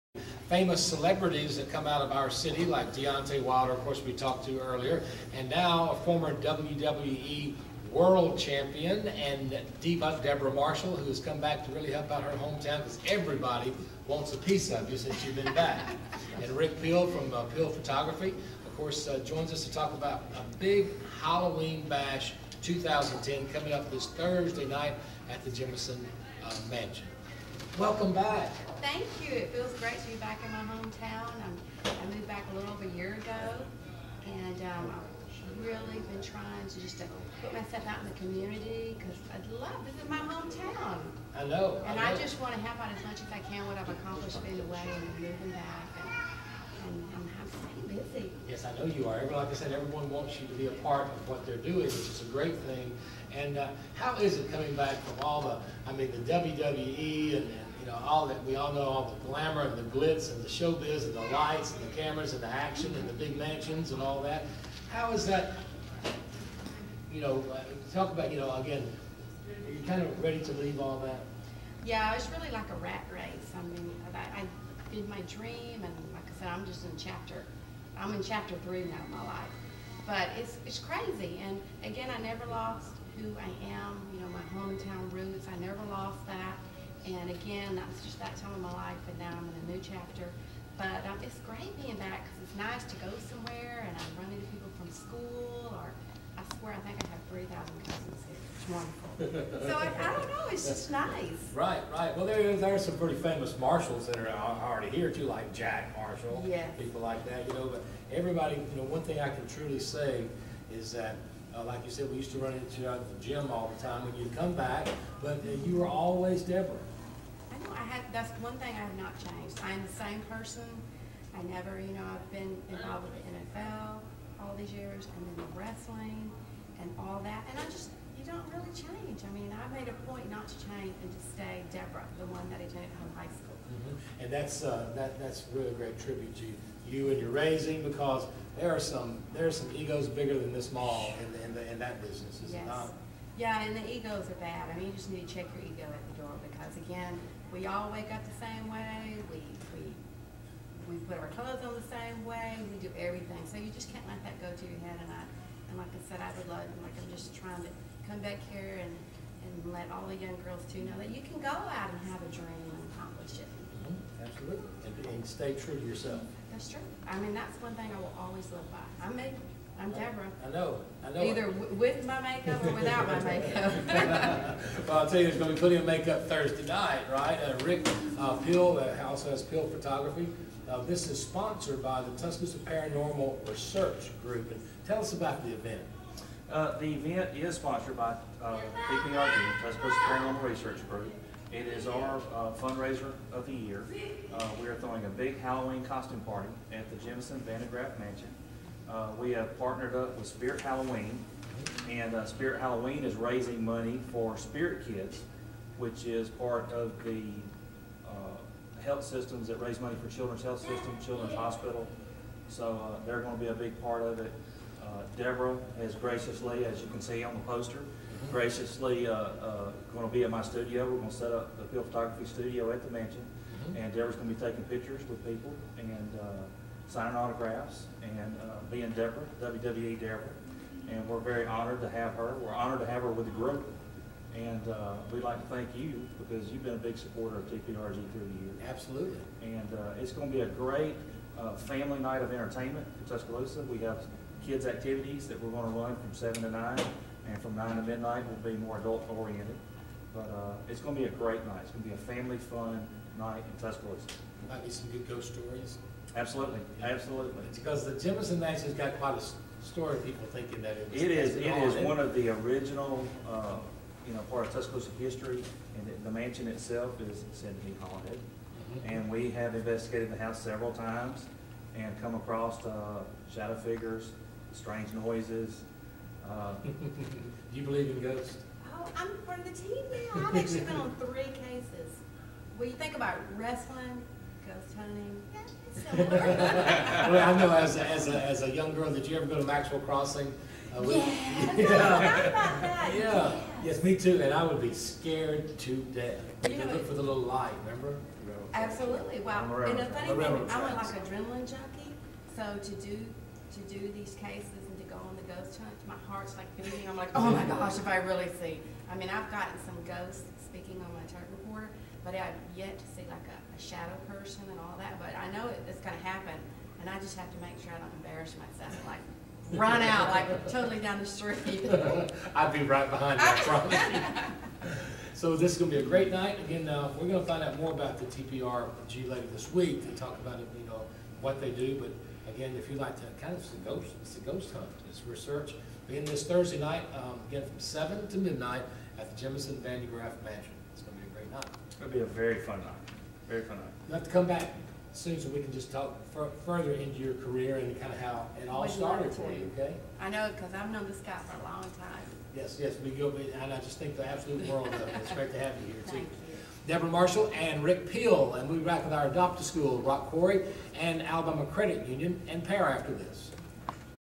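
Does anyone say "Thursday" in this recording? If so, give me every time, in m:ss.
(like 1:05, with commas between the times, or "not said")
0:24, 2:56, 5:36.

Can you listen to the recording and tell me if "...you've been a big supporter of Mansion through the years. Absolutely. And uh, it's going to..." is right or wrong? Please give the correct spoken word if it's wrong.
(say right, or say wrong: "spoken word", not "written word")
wrong: "TPRG", not "Mansion".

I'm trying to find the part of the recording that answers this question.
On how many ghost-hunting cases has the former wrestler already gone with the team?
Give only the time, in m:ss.
4:40.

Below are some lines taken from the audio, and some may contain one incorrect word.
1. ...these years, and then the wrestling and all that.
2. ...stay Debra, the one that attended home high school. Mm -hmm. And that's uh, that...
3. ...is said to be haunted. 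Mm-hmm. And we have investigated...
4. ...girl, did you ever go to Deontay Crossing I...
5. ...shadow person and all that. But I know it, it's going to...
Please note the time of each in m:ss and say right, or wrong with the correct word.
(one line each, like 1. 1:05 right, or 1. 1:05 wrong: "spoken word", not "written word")
1. 2:04 right
2. 2:11 right
3. 4:27 right
4. 4:48 wrong: "Maxwell", not "Deontay"
5. 5:13 right.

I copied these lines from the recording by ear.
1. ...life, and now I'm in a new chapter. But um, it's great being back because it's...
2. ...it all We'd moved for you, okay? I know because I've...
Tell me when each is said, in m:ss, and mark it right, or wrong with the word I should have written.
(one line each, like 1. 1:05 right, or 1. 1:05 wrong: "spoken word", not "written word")
1. 1:28 right
2. 5:48 wrong: "started", not "moved".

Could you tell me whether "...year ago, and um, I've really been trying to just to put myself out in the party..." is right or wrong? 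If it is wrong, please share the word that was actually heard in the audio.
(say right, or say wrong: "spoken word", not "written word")
wrong: "community", not "party".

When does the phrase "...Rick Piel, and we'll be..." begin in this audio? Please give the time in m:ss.
5:57.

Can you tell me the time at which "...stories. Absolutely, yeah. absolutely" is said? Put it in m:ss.
4:15.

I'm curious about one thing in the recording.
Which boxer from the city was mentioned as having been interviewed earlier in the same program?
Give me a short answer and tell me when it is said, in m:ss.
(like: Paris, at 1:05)
Deontay Wilder, at 0:02.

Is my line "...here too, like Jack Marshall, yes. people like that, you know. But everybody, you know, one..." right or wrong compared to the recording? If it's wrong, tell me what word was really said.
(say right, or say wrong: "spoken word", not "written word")
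right.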